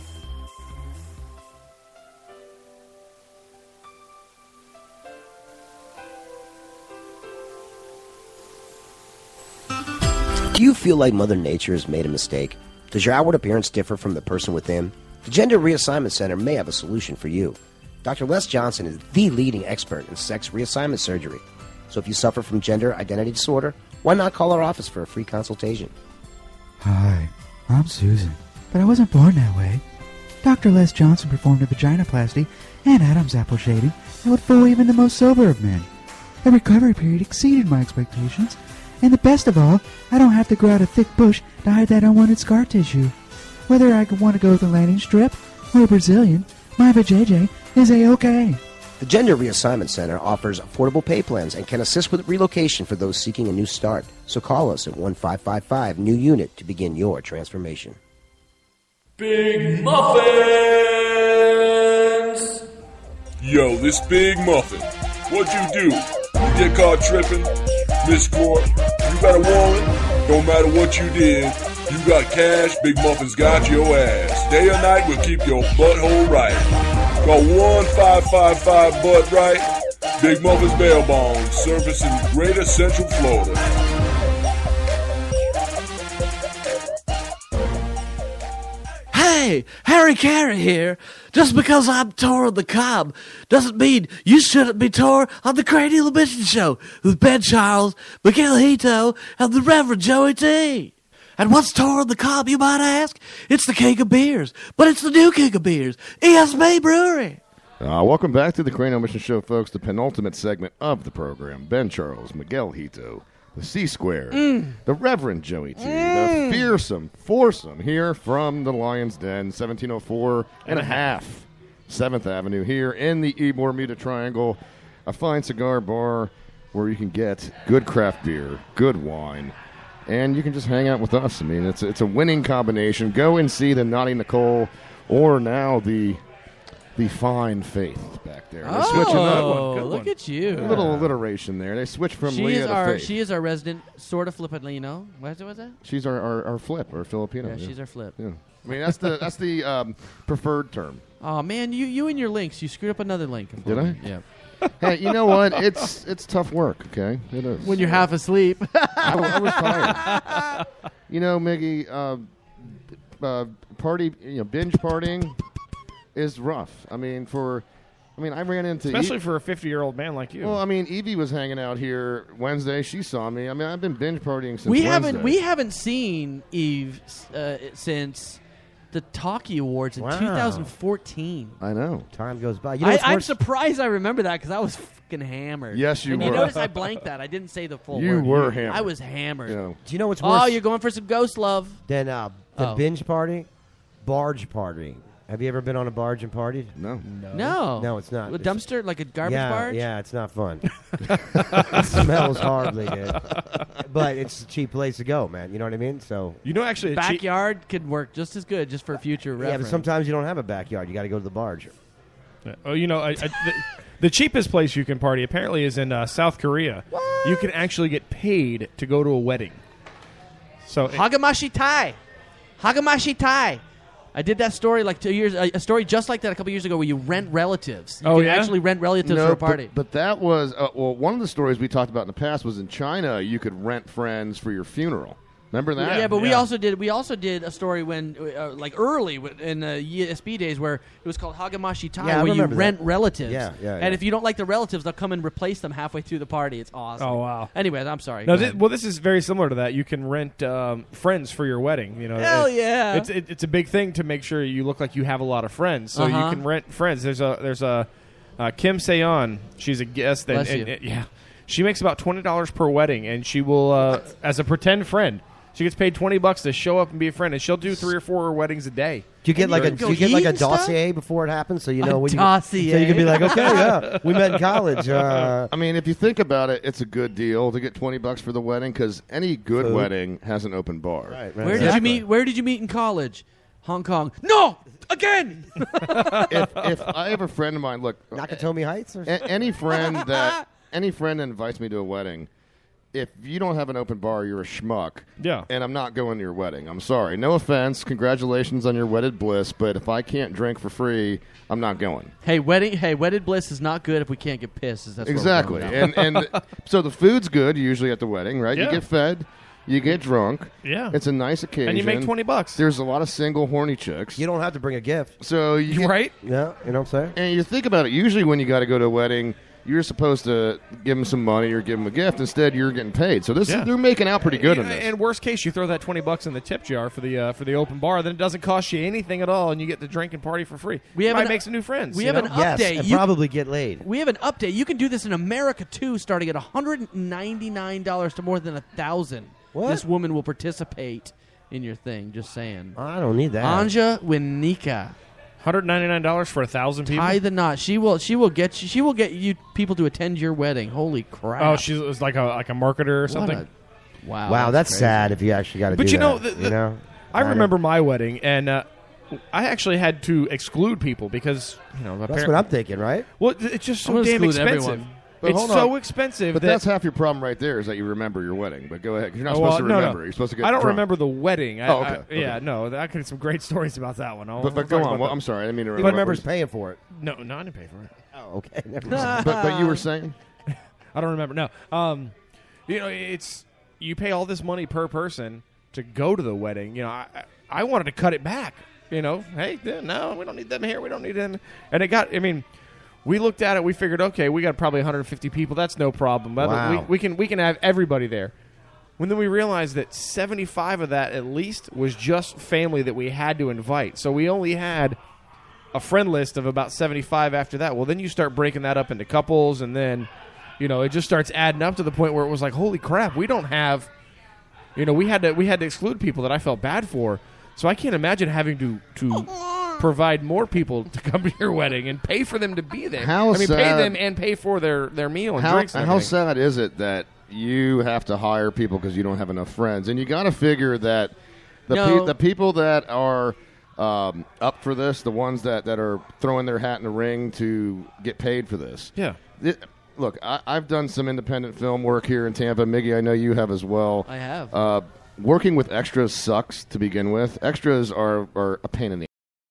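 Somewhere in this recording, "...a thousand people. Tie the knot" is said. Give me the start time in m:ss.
5:46.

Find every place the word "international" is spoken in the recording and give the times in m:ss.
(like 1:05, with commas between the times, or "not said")
not said.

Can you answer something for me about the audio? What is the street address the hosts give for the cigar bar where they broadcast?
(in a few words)
1704 and a half 7th Avenue.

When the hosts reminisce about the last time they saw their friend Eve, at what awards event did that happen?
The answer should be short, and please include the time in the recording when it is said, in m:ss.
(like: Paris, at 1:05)
Talkie Awards, at 2:59.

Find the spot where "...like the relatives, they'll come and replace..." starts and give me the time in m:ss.
4:04.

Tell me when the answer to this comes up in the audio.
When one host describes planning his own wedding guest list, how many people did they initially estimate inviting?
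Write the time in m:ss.
6:34.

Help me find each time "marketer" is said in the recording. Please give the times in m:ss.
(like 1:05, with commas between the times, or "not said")
5:52.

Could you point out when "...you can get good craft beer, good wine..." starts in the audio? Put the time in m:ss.
2:06.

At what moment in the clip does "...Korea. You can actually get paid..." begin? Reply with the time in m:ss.
3:36.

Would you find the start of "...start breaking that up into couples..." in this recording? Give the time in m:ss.
6:48.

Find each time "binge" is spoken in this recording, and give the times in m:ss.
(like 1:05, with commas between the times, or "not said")
2:44, 2:53, 3:12.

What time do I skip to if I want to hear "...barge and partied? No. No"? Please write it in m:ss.
3:15.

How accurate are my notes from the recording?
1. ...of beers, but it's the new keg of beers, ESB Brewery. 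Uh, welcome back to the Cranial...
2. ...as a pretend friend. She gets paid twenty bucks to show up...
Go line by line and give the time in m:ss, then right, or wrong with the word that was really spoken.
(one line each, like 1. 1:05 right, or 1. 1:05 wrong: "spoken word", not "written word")
1. 1:43 right
2. 4:24 right.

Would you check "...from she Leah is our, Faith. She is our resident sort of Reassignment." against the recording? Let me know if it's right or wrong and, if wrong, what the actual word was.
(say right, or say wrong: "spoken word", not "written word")
wrong: "Filipino", not "Reassignment".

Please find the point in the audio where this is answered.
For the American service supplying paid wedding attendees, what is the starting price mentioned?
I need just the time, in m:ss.
5:36.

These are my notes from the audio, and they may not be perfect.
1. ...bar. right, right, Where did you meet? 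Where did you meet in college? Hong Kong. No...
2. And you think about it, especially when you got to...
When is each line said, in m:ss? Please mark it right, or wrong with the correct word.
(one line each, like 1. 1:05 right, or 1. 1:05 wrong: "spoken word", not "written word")
1. 4:40 right
2. 5:17 wrong: "usually", not "especially".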